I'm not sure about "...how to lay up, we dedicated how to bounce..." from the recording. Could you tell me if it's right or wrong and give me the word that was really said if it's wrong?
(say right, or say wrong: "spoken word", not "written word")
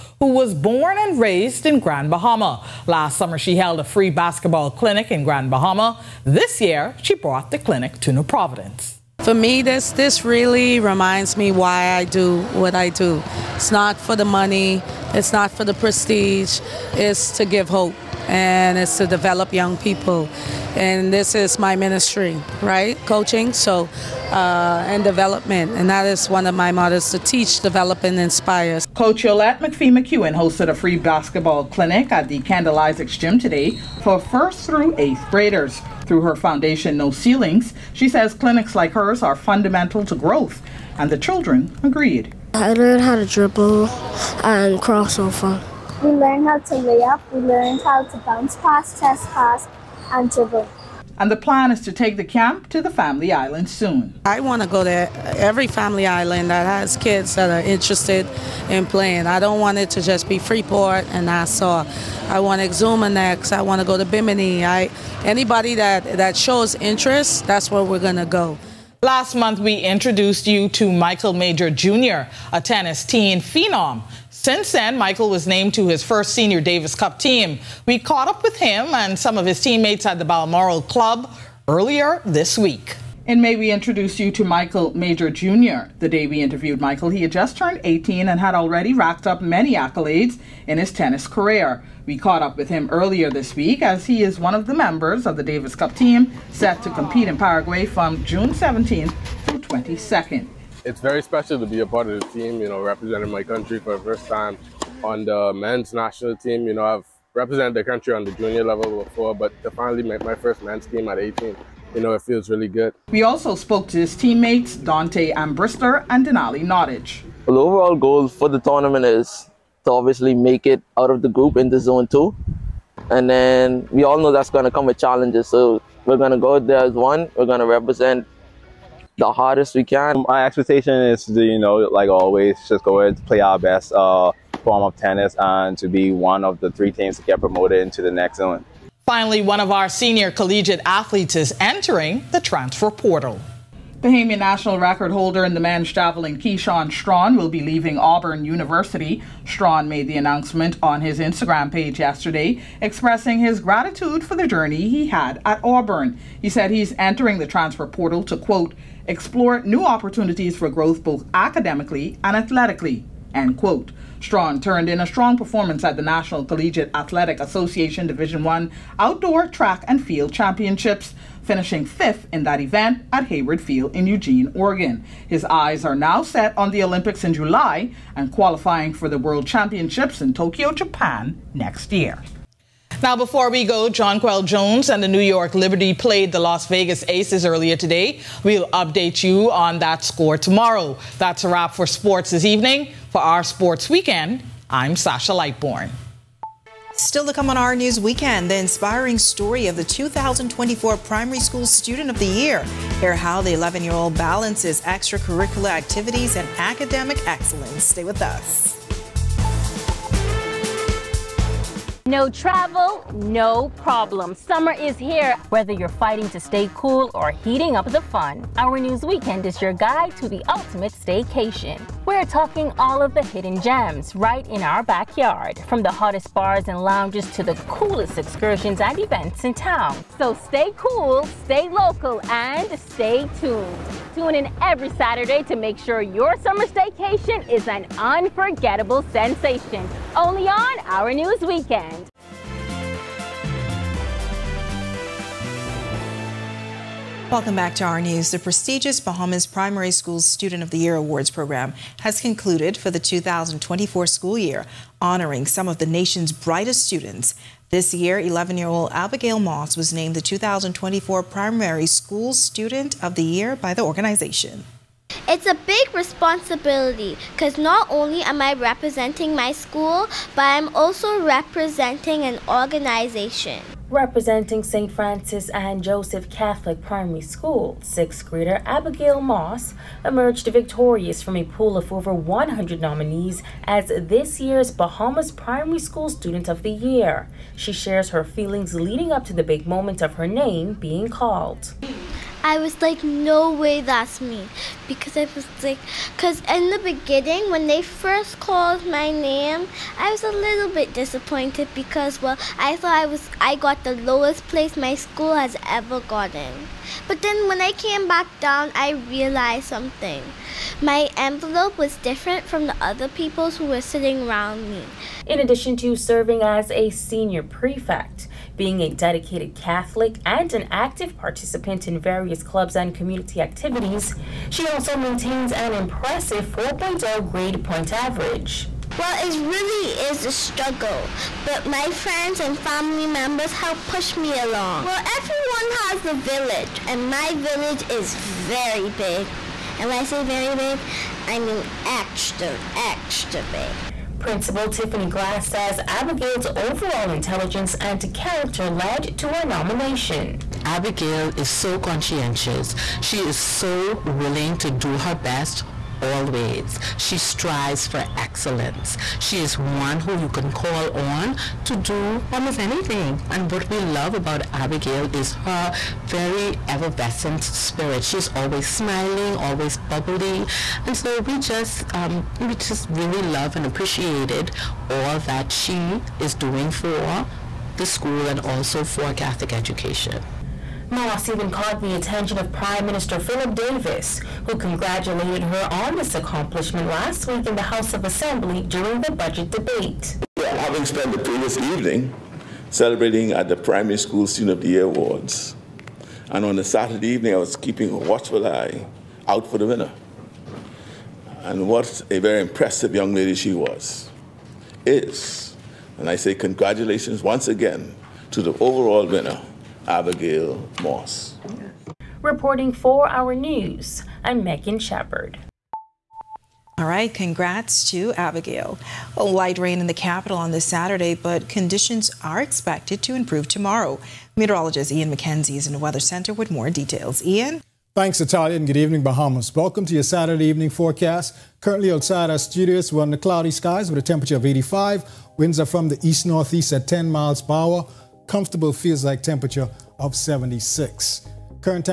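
wrong: "learned", not "dedicated".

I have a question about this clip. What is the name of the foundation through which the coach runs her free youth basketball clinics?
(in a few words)
No Ceilings.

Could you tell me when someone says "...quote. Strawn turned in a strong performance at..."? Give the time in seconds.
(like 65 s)
163 s.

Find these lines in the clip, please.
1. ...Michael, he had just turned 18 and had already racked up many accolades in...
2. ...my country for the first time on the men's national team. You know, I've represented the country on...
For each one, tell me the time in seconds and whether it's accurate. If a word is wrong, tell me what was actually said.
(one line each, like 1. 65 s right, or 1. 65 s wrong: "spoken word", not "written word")
1. 86 s right
2. 103 s right.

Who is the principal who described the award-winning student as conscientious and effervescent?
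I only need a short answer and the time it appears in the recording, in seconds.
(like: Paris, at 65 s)
Tiffany Glass, at 344 s.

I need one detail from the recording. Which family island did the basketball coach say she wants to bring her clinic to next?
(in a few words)
Exuma.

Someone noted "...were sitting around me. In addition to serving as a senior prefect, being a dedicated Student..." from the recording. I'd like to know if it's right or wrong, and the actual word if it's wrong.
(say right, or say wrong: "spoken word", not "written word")
wrong: "Catholic", not "Student".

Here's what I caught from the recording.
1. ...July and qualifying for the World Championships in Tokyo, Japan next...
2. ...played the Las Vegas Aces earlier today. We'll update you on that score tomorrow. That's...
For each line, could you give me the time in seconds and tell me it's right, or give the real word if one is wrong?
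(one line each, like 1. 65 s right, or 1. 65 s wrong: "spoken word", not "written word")
1. 177 s right
2. 185 s right.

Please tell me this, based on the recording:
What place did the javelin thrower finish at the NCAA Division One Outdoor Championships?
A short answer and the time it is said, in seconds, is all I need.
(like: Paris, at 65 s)
fifth, at 171 s.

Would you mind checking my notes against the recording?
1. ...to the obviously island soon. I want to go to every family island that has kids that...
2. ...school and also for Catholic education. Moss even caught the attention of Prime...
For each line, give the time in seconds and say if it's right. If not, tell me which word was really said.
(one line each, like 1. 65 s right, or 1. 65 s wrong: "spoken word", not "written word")
1. 52 s wrong: "family", not "obviously"
2. 377 s right.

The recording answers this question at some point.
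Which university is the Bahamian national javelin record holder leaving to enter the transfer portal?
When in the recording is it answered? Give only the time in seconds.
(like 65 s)
147 s.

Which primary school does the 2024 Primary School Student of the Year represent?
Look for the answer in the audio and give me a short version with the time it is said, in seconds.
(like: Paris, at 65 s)
St. Francis and Joseph Catholic Primary School, at 274 s.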